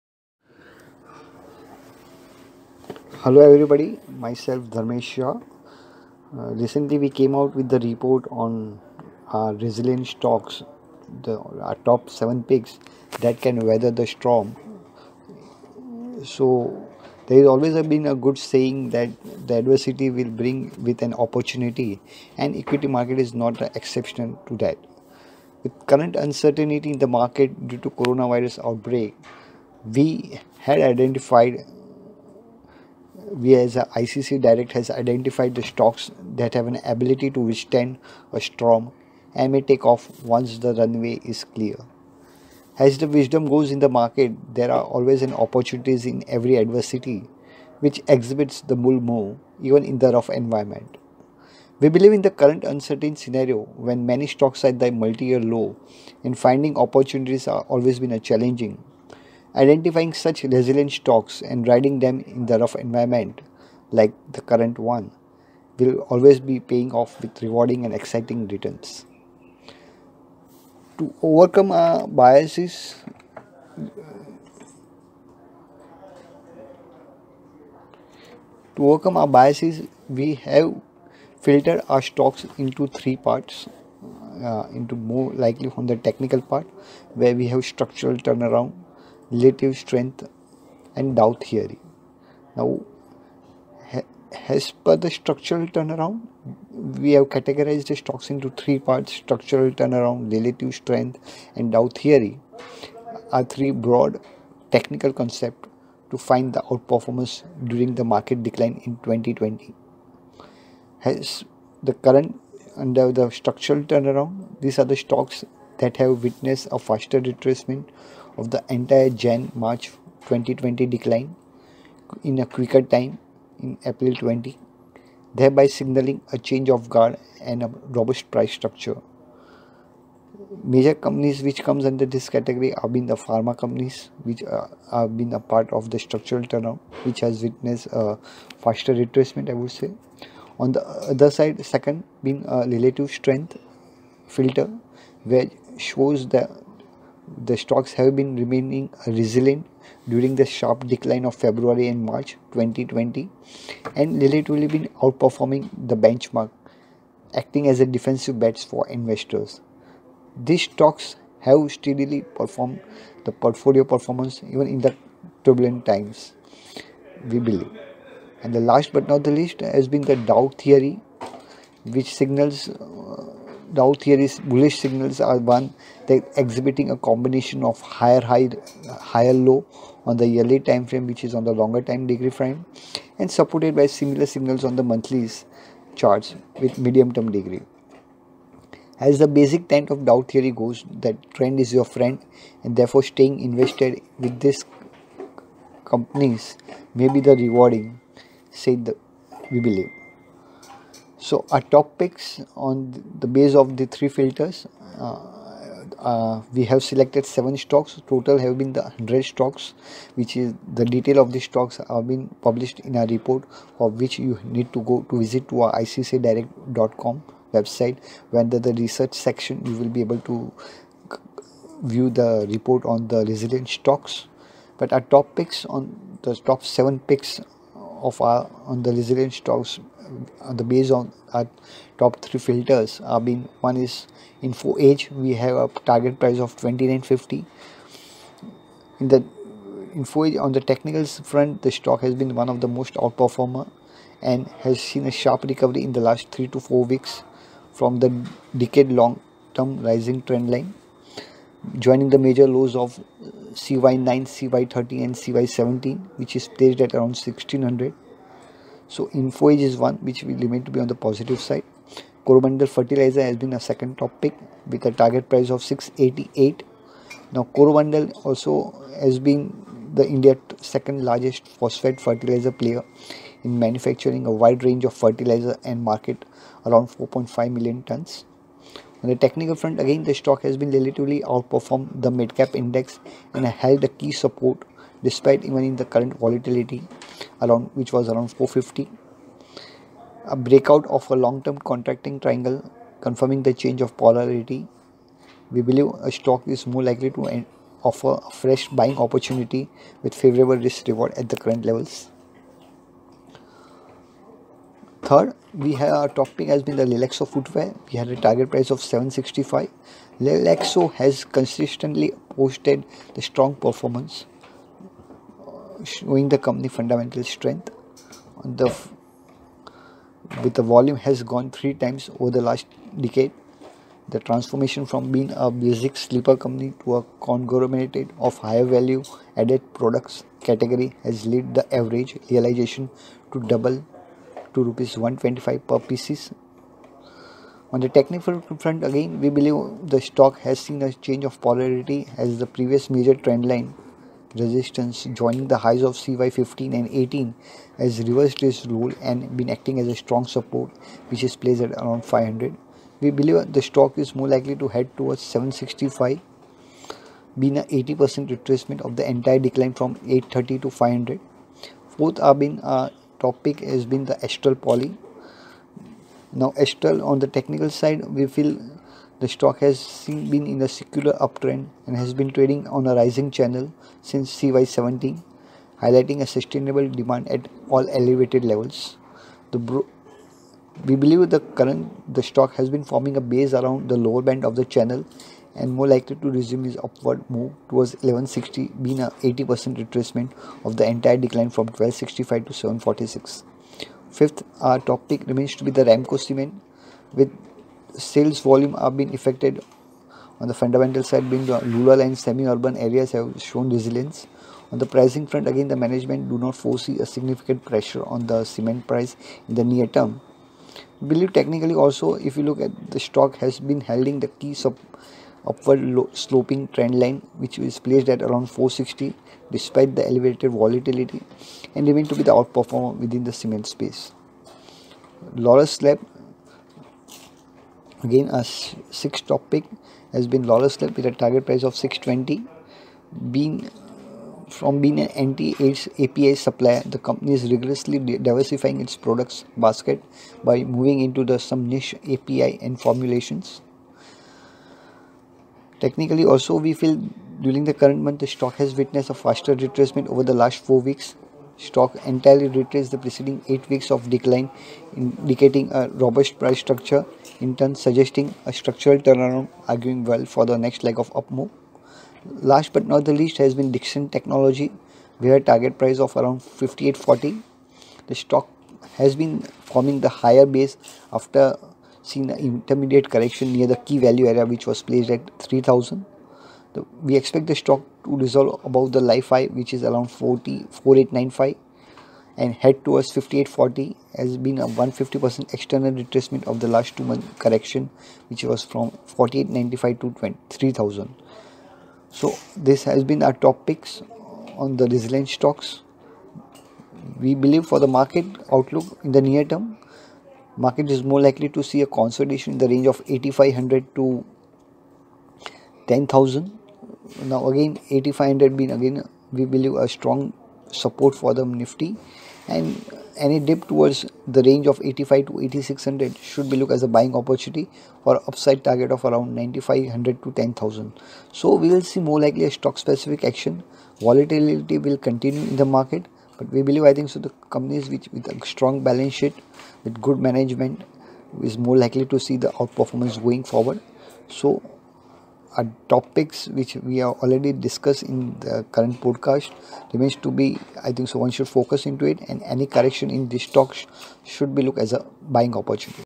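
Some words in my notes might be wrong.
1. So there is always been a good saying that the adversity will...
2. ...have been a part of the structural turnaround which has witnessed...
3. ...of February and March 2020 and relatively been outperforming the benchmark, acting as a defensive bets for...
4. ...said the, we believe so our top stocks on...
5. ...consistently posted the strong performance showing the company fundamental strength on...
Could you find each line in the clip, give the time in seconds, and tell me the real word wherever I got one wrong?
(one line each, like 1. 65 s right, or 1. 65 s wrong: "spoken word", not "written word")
1. 16 s right
2. 134 s right
3. 151 s right
4. 198 s wrong: "picks", not "stocks"
5. 311 s right.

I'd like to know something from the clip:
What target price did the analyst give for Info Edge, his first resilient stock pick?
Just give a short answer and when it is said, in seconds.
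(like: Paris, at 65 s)
2950, at 236 s.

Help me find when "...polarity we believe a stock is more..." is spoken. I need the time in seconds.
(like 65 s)
293 s.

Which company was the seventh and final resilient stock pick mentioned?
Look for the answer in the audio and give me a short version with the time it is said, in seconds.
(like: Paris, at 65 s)
Dixon Technology, at 463 s.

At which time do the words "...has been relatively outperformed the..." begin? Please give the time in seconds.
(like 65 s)
280 s.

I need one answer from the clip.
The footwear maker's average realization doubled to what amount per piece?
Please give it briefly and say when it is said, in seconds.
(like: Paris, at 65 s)
125 rupees, at 334 s.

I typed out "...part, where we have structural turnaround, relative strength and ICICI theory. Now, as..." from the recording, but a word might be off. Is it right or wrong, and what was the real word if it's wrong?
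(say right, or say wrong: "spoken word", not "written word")
wrong: "Dow", not "ICICI".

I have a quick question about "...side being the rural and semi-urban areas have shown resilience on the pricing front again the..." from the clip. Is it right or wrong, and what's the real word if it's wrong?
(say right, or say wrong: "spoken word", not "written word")
right.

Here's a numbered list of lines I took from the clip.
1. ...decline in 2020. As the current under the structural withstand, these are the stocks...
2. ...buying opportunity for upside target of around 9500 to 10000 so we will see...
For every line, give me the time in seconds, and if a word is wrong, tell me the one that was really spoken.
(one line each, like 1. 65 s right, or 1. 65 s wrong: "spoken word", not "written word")
1. 108 s wrong: "turnaround", not "withstand"
2. 516 s right.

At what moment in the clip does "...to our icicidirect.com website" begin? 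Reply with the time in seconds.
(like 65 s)
215 s.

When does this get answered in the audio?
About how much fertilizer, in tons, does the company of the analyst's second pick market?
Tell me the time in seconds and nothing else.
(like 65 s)
276 s.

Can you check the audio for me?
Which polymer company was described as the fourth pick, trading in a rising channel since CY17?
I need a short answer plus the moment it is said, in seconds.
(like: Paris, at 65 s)
Astral Poly, at 364 s.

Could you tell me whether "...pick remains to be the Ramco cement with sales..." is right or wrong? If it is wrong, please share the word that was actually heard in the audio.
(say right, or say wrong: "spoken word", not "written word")
right.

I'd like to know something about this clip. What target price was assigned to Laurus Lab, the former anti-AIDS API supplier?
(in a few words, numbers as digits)
620.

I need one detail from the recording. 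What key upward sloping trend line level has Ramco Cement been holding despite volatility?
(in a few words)
460.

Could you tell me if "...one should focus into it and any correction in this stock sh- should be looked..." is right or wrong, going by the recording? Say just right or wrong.
right.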